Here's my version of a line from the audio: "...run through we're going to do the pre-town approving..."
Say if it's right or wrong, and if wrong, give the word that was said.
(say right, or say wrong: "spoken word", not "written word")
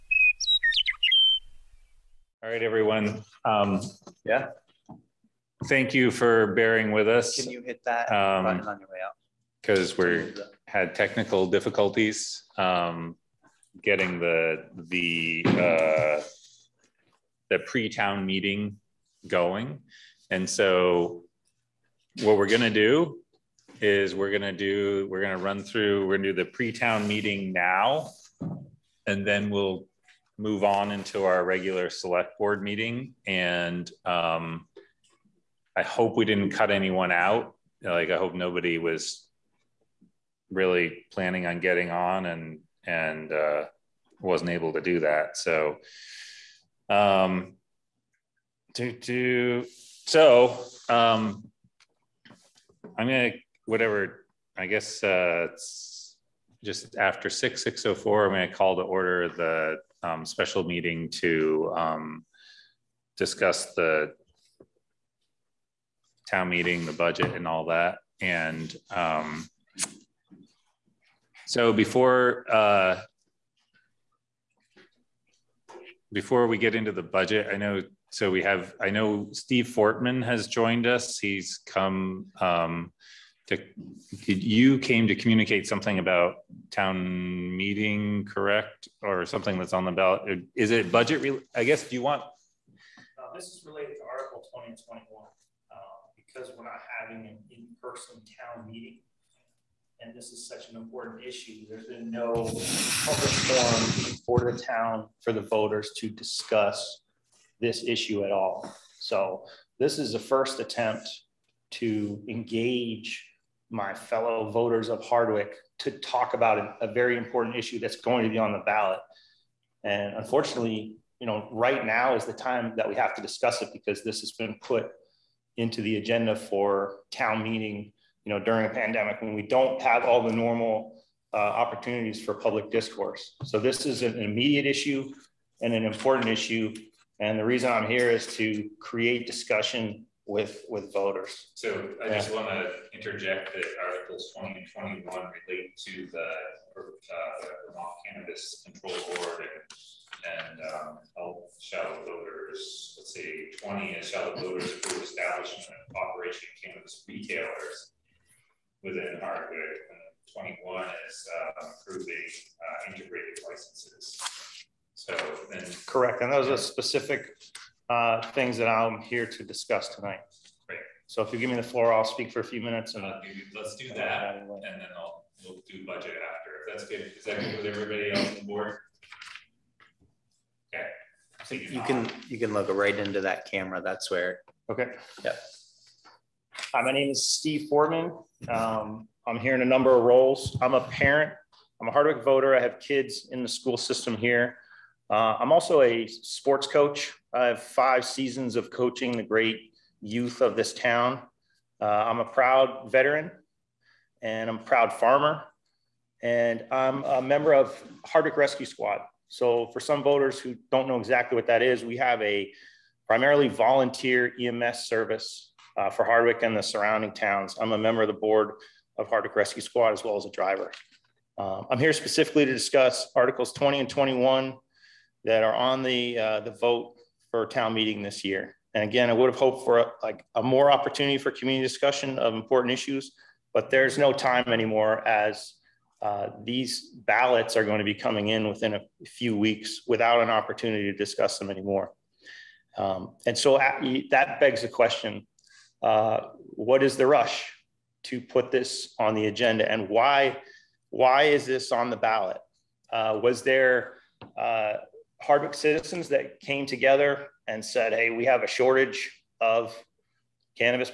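wrong: "meeting", not "approving".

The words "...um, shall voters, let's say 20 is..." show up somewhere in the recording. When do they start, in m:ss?
2:30.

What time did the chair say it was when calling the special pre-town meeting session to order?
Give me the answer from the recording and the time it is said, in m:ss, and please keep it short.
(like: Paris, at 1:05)
6:04, at 0:57.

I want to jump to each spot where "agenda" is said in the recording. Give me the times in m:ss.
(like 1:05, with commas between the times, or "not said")
2:05, 4:09.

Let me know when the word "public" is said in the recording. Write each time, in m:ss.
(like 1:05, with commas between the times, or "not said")
1:42, 2:12.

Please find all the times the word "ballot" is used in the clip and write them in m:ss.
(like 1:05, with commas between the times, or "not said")
1:29, 1:58, 3:56, 4:11.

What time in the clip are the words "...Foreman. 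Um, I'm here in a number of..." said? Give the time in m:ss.
3:07.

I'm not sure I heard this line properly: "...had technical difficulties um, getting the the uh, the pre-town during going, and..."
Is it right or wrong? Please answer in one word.
wrong.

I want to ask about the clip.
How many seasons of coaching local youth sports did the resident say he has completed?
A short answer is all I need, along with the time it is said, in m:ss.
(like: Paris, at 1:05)
5, at 3:17.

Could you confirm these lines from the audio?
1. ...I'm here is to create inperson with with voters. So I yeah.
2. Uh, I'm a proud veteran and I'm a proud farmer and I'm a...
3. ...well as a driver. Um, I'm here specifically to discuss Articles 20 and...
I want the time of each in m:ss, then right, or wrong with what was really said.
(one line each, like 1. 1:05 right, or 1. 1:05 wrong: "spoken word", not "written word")
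1. 2:17 wrong: "discussion", not "inperson"
2. 3:21 right
3. 3:40 right.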